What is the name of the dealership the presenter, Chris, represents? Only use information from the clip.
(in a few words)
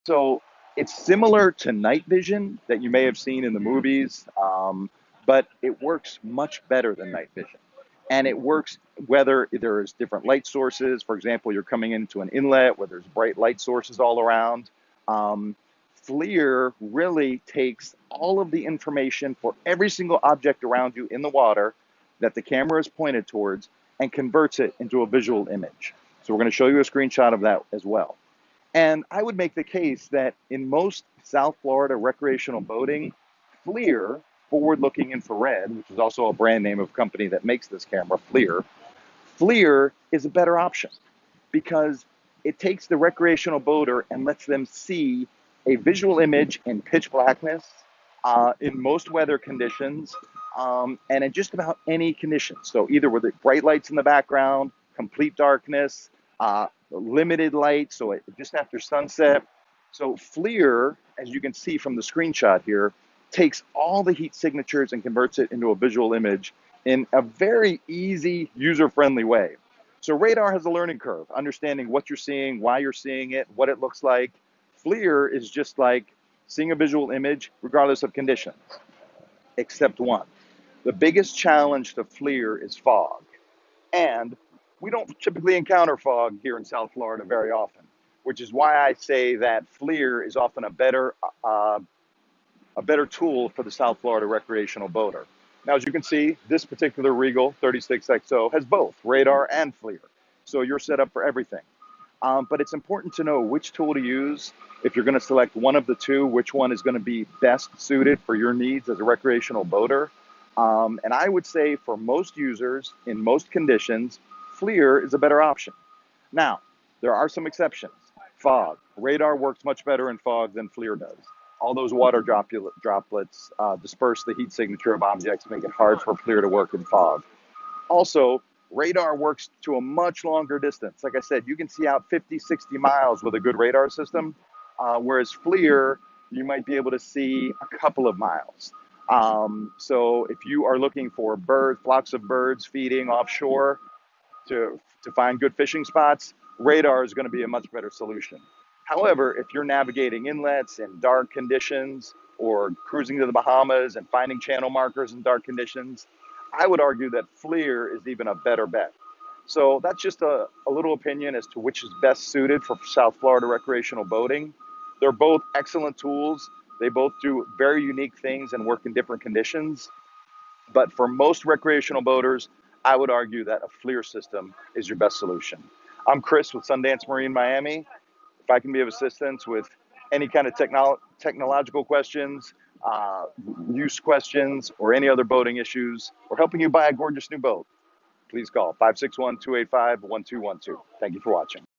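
Sundance Marine Miami.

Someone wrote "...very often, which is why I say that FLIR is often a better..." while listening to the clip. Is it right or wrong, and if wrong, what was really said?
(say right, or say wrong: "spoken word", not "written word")
right.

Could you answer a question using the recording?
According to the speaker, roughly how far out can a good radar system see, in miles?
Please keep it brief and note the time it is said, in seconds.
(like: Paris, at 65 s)
50-60 miles, at 132 s.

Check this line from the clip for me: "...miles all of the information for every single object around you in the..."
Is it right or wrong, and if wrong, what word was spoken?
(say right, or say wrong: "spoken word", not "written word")
wrong: "takes", not "miles".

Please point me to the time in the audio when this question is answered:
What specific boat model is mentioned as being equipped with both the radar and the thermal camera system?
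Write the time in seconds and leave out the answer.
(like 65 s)
97 s.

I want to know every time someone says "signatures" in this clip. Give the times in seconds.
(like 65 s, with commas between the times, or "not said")
64 s, 124 s.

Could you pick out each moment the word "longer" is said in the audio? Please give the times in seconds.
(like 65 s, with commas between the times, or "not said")
130 s.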